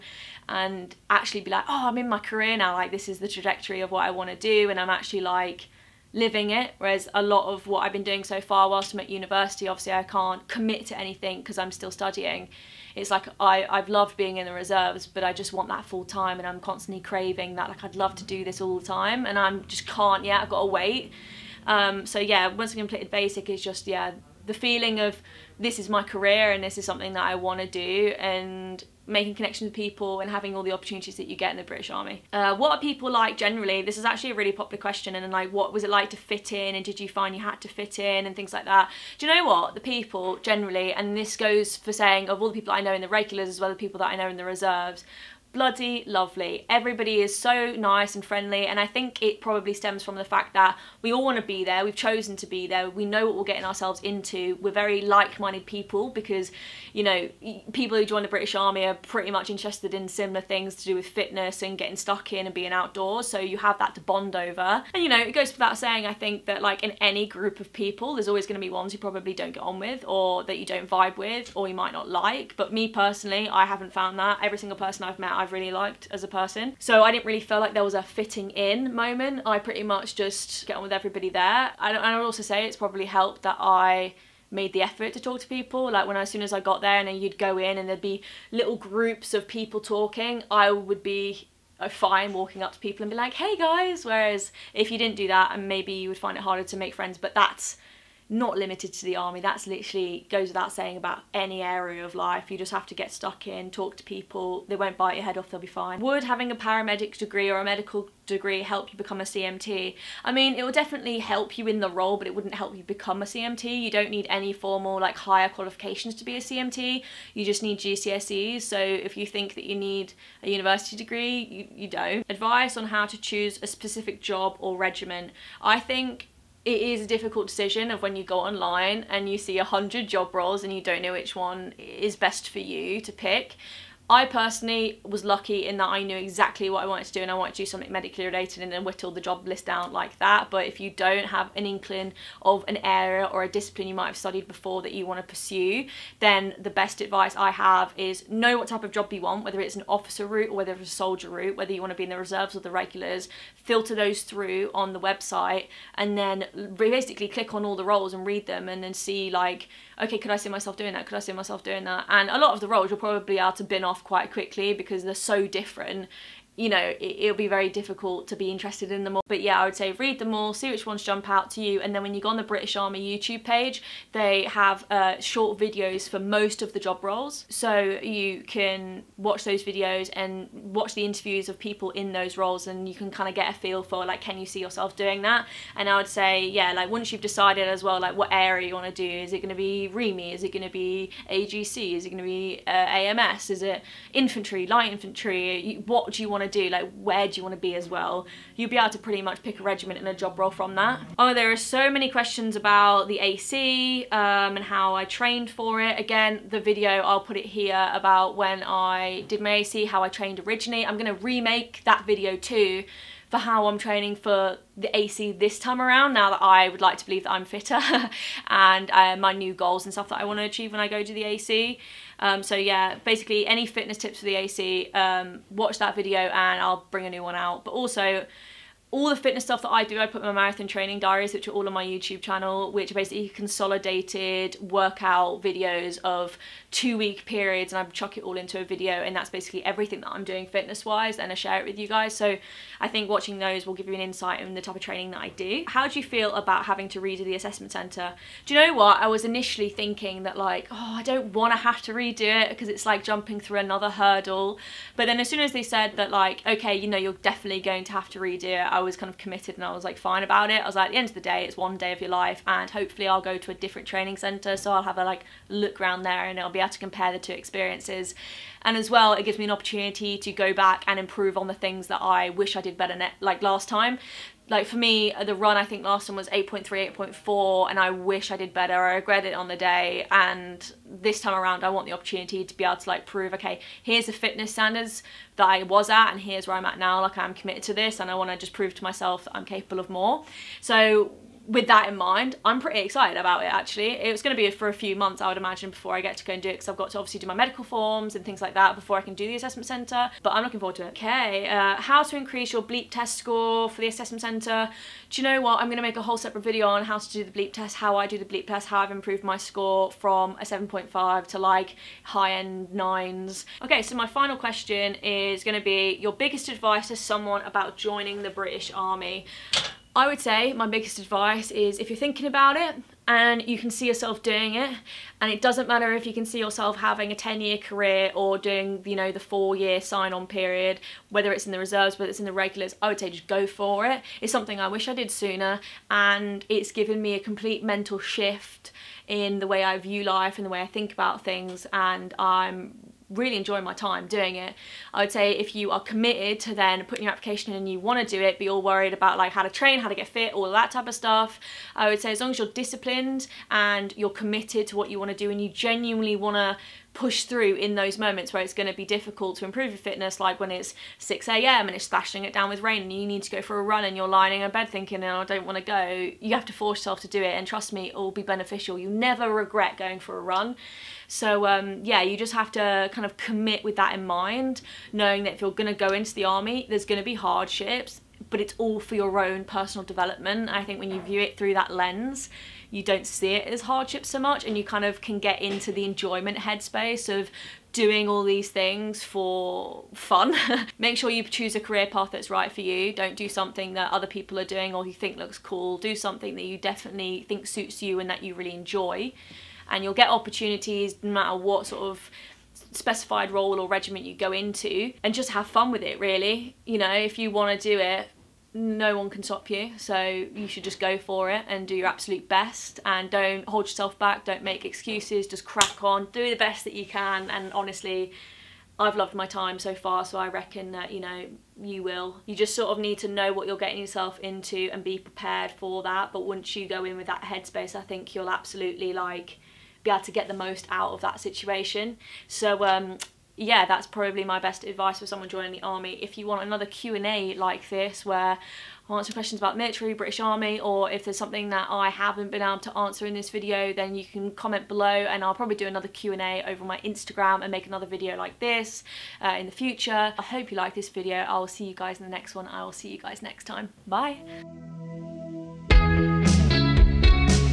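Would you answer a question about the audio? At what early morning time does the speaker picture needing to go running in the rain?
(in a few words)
6 a.m.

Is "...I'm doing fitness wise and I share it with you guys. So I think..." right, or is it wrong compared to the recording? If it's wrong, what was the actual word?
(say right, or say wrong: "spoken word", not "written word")
right.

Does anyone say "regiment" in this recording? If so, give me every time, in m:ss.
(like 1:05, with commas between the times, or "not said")
2:04, 3:19, 6:43.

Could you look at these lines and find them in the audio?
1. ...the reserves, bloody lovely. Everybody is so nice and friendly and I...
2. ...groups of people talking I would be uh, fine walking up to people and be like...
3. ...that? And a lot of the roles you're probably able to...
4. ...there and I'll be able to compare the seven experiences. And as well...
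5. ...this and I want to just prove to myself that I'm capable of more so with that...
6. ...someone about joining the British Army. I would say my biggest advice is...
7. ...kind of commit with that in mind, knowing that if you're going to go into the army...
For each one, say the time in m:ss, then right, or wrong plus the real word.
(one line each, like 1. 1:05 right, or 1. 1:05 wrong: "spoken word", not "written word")
1. 0:44 right
2. 1:28 right
3. 2:41 right
4. 4:26 wrong: "two", not "seven"
5. 4:47 right
6. 5:16 right
7. 6:12 right.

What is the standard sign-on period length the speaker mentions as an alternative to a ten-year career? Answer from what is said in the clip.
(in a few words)
4 years.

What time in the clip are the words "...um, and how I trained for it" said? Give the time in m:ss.
3:24.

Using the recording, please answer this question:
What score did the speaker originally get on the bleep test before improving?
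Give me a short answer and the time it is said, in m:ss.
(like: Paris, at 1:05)
7.5, at 5:10.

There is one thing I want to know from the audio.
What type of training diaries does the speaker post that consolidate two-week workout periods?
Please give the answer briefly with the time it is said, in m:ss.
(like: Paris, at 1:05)
marathon training diaries, at 3:50.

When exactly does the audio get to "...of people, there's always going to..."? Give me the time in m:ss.
1:07.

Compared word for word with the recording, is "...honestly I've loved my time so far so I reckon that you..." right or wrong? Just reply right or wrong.
right.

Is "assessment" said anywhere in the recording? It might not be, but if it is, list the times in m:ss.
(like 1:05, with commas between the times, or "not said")
4:07, 4:59, 5:03.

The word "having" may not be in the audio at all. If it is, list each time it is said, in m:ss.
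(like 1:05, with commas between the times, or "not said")
0:30, 1:46, 4:06, 5:26.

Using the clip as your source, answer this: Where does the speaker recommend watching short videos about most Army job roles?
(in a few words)
British Army YouTube page.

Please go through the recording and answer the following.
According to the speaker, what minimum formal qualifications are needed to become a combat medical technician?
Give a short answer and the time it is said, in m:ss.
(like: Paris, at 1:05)
GCSEs, at 1:57.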